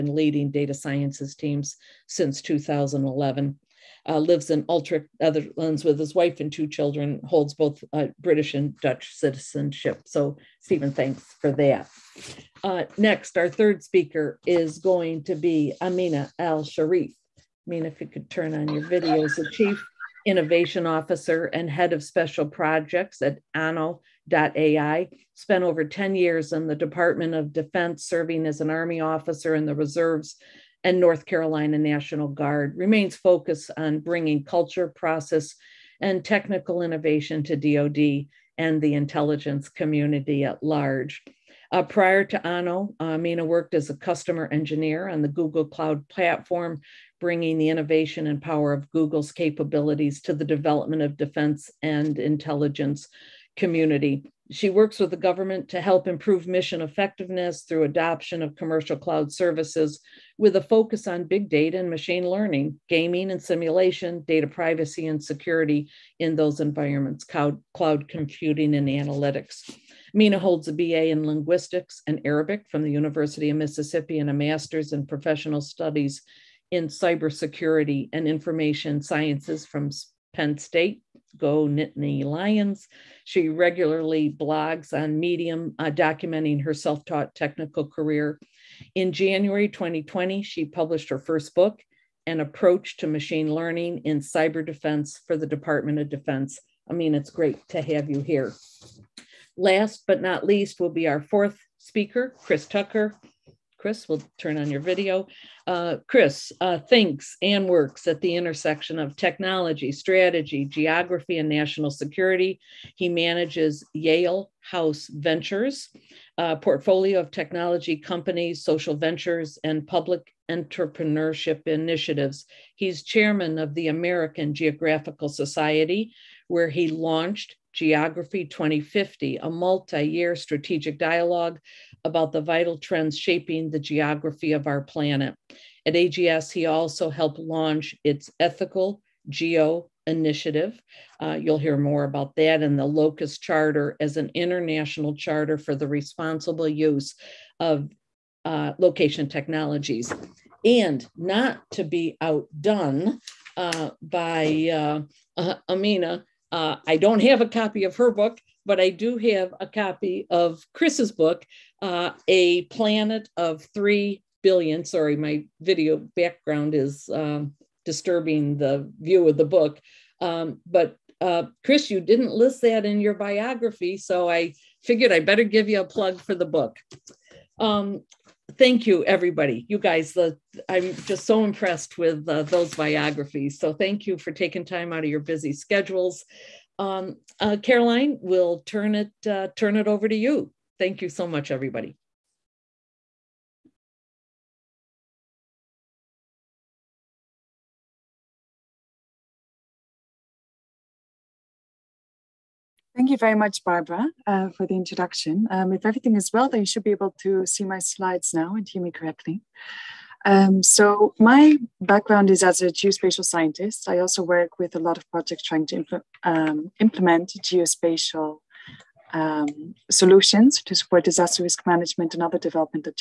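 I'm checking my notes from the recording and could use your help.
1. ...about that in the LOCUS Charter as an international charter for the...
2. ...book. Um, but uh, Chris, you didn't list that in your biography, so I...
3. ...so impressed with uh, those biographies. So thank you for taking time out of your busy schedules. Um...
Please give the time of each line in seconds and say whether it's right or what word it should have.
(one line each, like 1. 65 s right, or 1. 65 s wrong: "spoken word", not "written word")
1. 142 s right
2. 169 s right
3. 181 s right.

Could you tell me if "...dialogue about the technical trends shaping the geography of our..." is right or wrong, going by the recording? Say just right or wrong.
wrong.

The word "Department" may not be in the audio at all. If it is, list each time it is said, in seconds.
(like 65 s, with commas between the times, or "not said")
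26 s, 95 s.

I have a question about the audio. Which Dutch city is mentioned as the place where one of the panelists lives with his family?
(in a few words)
Utrecht.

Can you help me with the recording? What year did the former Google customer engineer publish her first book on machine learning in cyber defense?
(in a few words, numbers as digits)
2020.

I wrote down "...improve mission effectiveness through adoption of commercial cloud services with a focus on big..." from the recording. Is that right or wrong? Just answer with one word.
right.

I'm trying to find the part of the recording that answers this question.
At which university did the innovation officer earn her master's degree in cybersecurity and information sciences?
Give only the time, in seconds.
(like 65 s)
80 s.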